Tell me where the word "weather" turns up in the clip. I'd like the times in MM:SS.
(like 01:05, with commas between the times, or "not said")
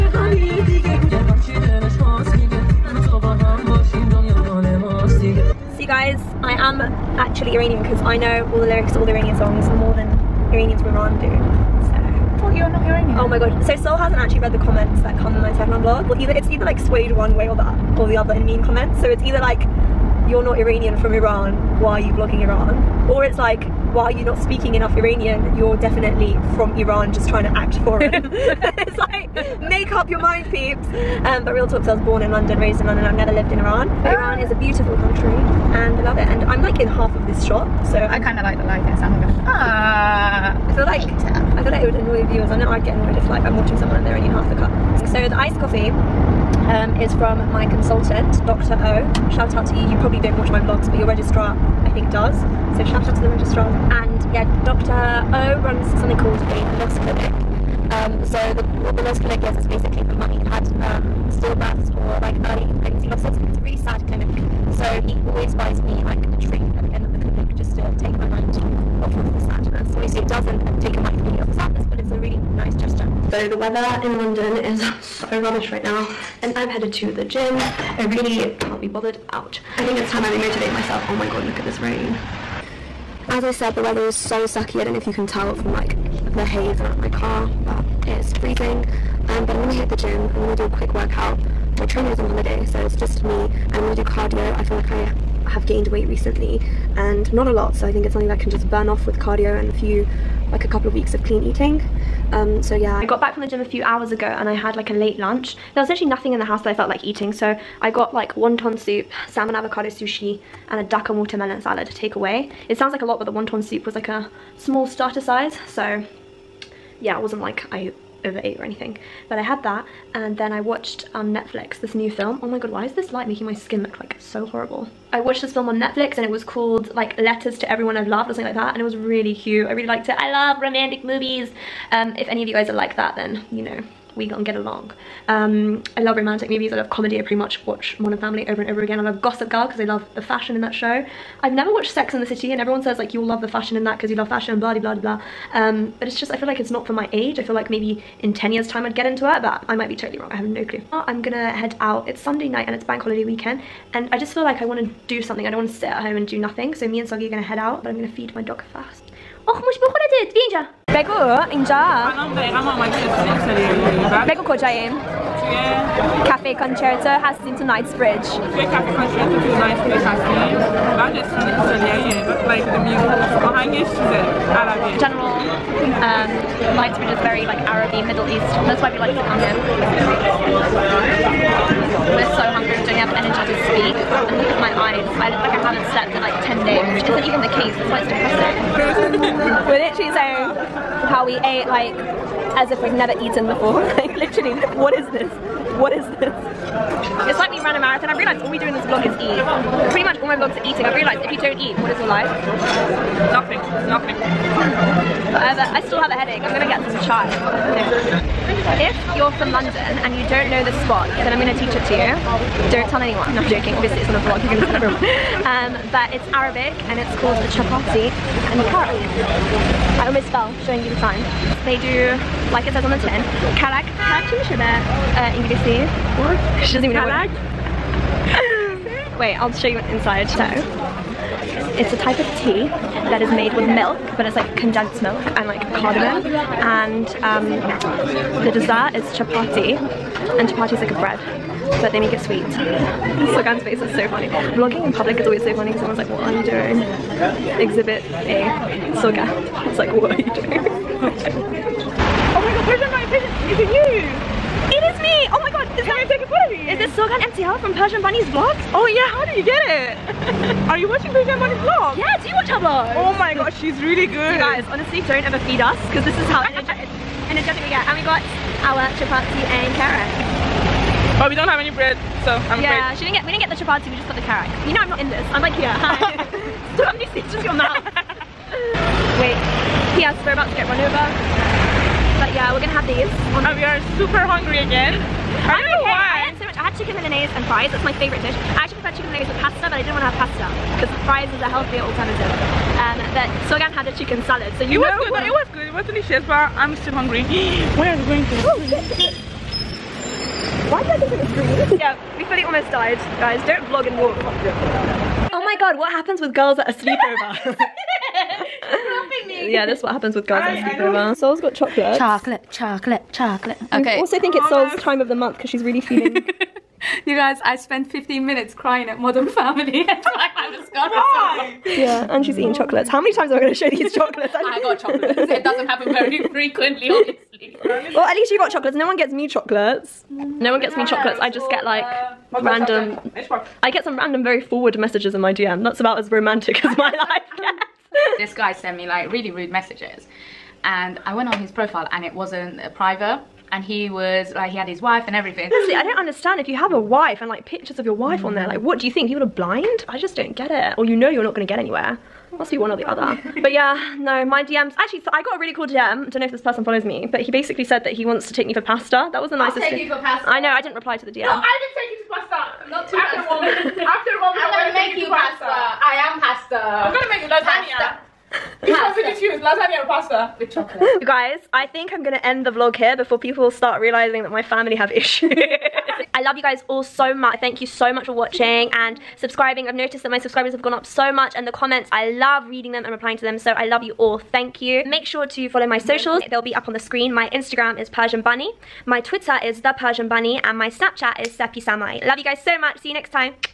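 01:13, 01:23.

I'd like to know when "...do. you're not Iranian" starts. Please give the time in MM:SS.
00:11.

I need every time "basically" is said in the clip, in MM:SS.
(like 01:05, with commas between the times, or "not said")
00:59, 05:57.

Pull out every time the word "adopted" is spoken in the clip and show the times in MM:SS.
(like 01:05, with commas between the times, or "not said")
not said.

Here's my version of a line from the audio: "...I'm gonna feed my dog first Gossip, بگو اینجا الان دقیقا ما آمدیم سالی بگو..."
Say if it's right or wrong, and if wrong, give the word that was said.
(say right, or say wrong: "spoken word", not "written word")
wrong: "Och", not "Gossip".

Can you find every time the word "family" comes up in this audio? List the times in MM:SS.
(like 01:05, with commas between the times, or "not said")
02:18, 05:19, 06:14.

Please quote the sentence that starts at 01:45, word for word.
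There was actually nothing in the house that I felt like eating.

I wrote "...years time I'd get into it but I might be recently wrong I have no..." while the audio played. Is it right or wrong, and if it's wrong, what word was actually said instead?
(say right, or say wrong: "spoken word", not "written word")
wrong: "totally", not "recently".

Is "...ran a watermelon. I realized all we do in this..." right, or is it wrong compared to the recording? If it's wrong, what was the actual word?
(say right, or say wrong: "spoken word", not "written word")
wrong: "marathon", not "watermelon".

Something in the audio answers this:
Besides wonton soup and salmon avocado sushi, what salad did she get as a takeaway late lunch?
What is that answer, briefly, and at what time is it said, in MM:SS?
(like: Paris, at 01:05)
watermelon salad, at 01:51.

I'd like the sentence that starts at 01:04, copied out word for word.
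So he always buys me like a treat at the end just to take my mind off of the sadness.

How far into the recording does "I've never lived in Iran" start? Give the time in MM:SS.
00:33.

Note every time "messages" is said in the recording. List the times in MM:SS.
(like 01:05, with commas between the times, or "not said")
05:34, 05:39.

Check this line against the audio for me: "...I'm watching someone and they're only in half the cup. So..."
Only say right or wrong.
right.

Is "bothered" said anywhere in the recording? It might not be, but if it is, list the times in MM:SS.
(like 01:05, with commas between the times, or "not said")
01:18.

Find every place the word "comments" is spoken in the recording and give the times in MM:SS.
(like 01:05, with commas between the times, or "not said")
00:14, 00:18, 06:21.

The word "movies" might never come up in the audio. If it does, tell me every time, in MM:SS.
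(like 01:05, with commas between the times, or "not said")
02:11, 02:16.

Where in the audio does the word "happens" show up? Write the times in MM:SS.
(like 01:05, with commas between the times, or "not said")
05:05, 05:09, 05:25.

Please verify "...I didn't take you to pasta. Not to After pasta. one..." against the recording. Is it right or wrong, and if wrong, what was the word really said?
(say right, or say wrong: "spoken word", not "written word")
right.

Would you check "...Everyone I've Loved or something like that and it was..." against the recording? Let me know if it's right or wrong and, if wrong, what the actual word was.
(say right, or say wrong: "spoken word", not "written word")
right.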